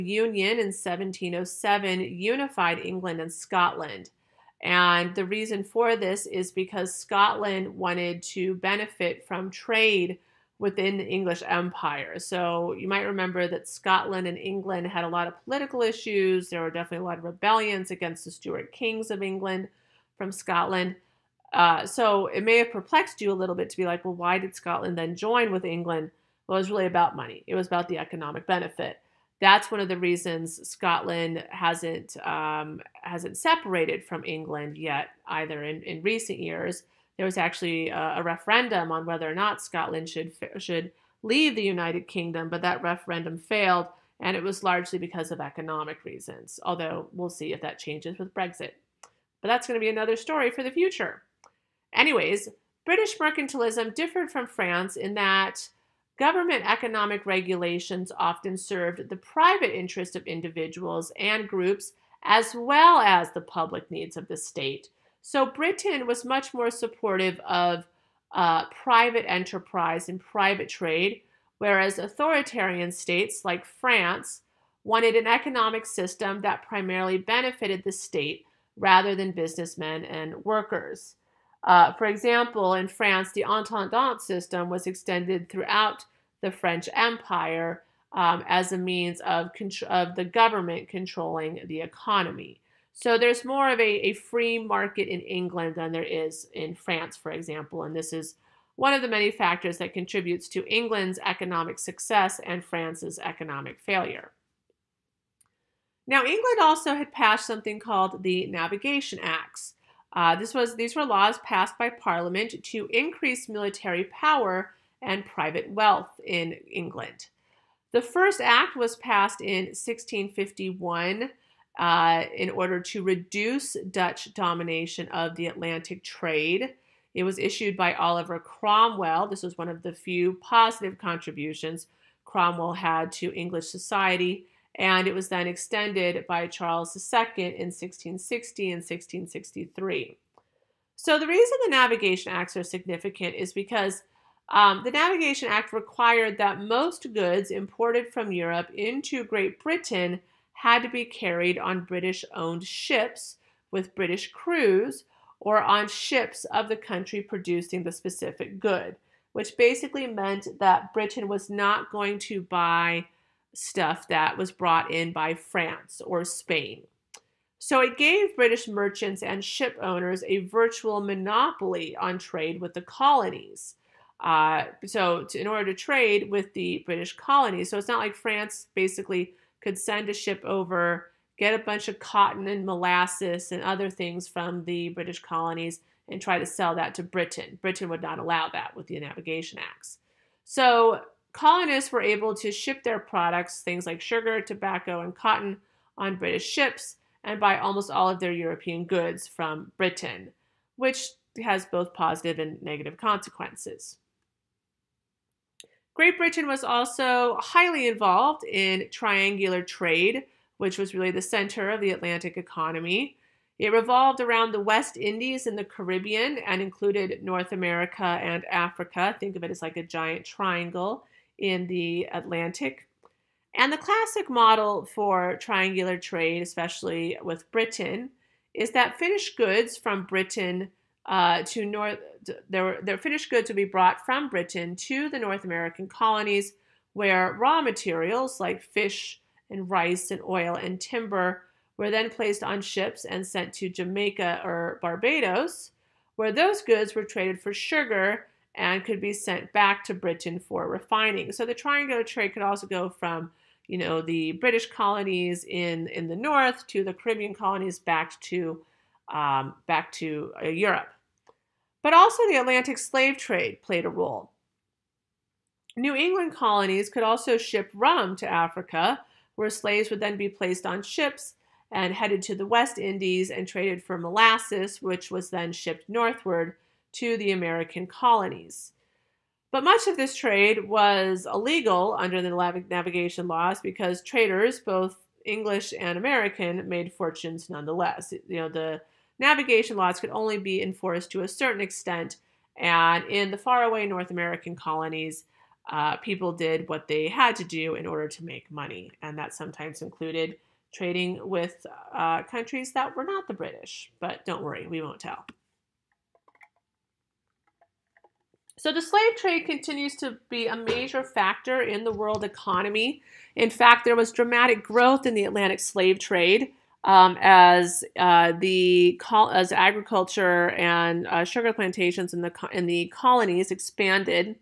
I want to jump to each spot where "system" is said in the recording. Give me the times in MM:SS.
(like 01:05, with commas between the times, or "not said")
01:15, 01:24.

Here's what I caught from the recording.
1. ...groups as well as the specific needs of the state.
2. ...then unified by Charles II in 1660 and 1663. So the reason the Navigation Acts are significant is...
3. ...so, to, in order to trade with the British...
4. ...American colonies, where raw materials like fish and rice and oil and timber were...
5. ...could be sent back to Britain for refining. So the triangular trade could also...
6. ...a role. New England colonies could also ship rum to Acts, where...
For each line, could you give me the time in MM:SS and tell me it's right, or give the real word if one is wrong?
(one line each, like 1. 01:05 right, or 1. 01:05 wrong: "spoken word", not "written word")
1. 01:01 wrong: "public", not "specific"
2. 02:15 wrong: "extended", not "unified"
3. 02:54 right
4. 03:55 right
5. 04:08 right
6. 04:23 wrong: "Africa", not "Acts".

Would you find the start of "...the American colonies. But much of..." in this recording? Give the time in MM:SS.
04:37.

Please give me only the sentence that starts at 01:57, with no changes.
The first act was passed in 1651 uh, in order to reduce Dutch domination of the Atlantic trade.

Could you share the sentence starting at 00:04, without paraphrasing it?
And the reason for this is because Scotland wanted to benefit from trade within the English Empire.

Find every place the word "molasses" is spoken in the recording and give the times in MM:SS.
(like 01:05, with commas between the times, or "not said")
03:02, 04:33.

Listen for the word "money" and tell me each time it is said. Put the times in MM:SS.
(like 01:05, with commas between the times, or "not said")
00:27, 04:58.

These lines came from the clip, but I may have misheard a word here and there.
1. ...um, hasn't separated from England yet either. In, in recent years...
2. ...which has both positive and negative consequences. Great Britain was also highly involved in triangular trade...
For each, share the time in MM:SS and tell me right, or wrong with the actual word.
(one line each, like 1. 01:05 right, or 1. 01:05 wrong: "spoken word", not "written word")
1. 00:32 right
2. 03:20 right.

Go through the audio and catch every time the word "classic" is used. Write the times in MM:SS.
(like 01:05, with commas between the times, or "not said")
03:43.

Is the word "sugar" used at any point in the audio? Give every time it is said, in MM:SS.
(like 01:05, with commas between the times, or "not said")
03:14, 04:07, 05:21.